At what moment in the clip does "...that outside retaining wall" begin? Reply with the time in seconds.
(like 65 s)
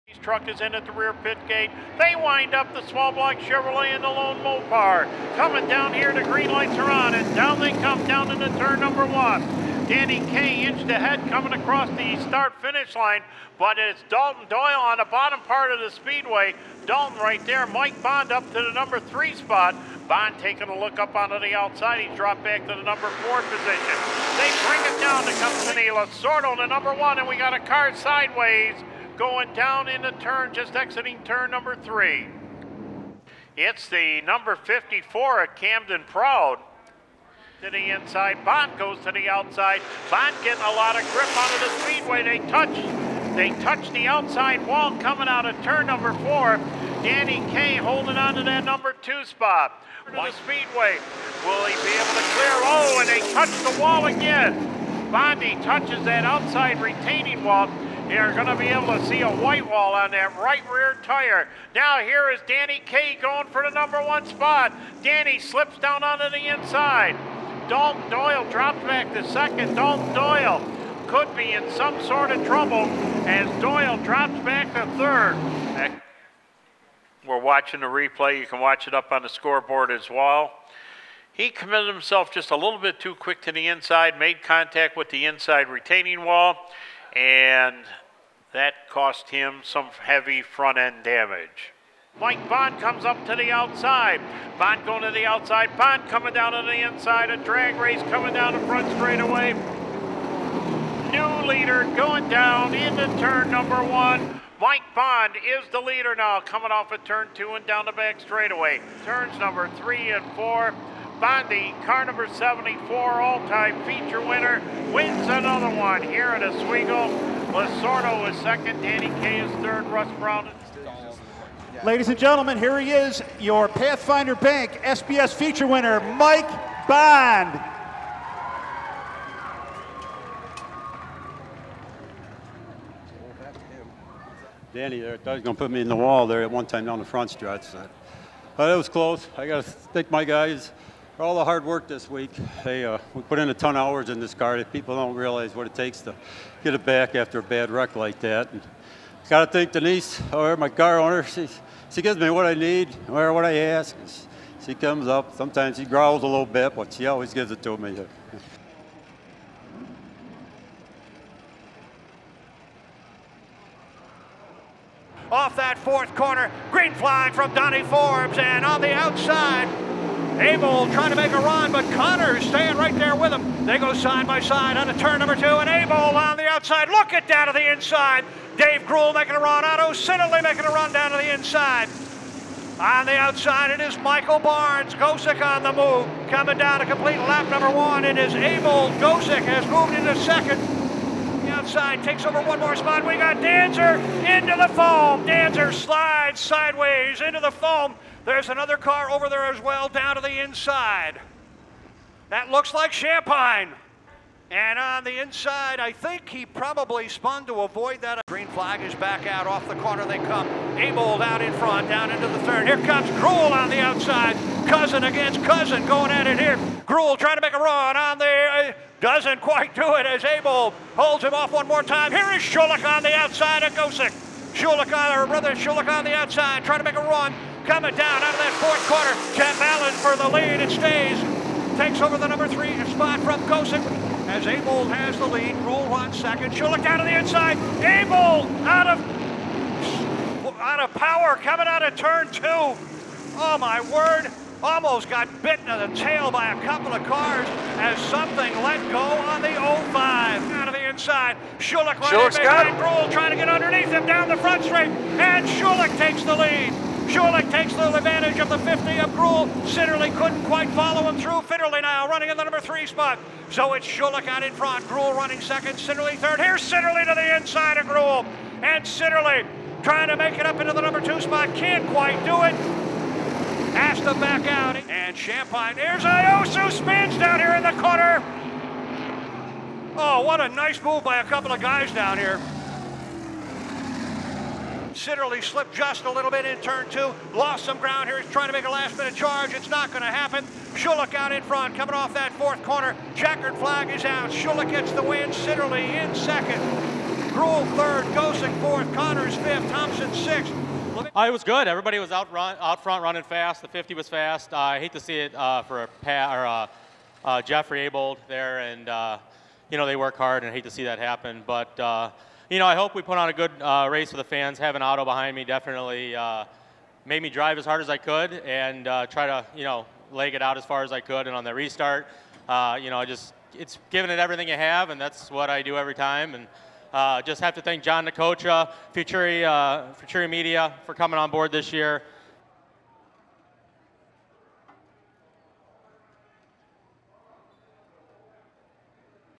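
56 s.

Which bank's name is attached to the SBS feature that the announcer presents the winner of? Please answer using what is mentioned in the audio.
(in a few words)
Pathfinder Bank.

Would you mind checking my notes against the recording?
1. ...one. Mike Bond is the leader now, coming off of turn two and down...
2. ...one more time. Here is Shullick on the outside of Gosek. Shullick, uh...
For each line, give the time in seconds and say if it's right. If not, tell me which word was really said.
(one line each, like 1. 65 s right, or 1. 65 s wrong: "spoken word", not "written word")
1. 103 s right
2. 221 s right.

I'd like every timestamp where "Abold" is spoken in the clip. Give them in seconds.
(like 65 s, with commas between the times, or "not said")
210 s, 307 s.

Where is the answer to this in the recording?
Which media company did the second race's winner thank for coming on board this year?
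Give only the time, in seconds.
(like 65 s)
328 s.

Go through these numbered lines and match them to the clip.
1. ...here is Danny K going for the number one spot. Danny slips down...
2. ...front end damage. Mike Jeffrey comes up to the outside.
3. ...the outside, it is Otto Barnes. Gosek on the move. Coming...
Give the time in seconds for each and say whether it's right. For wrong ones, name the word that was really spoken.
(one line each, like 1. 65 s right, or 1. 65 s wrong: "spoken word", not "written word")
1. 61 s right
2. 90 s wrong: "Bond", not "Jeffrey"
3. 183 s wrong: "Michael", not "Otto".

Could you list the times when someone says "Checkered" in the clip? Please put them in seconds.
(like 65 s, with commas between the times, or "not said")
293 s.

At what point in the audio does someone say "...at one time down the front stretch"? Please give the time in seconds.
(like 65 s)
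136 s.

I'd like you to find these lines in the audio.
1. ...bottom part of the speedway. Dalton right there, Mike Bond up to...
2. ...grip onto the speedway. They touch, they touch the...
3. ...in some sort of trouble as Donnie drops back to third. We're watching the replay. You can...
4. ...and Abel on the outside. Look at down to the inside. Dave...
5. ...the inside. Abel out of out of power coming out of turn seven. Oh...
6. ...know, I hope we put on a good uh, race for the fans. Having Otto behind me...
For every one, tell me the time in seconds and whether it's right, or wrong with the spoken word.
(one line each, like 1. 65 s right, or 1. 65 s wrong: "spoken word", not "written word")
1. 15 s right
2. 41 s right
3. 71 s wrong: "Doyle", not "Donnie"
4. 175 s right
5. 237 s wrong: "two", not "seven"
6. 312 s right.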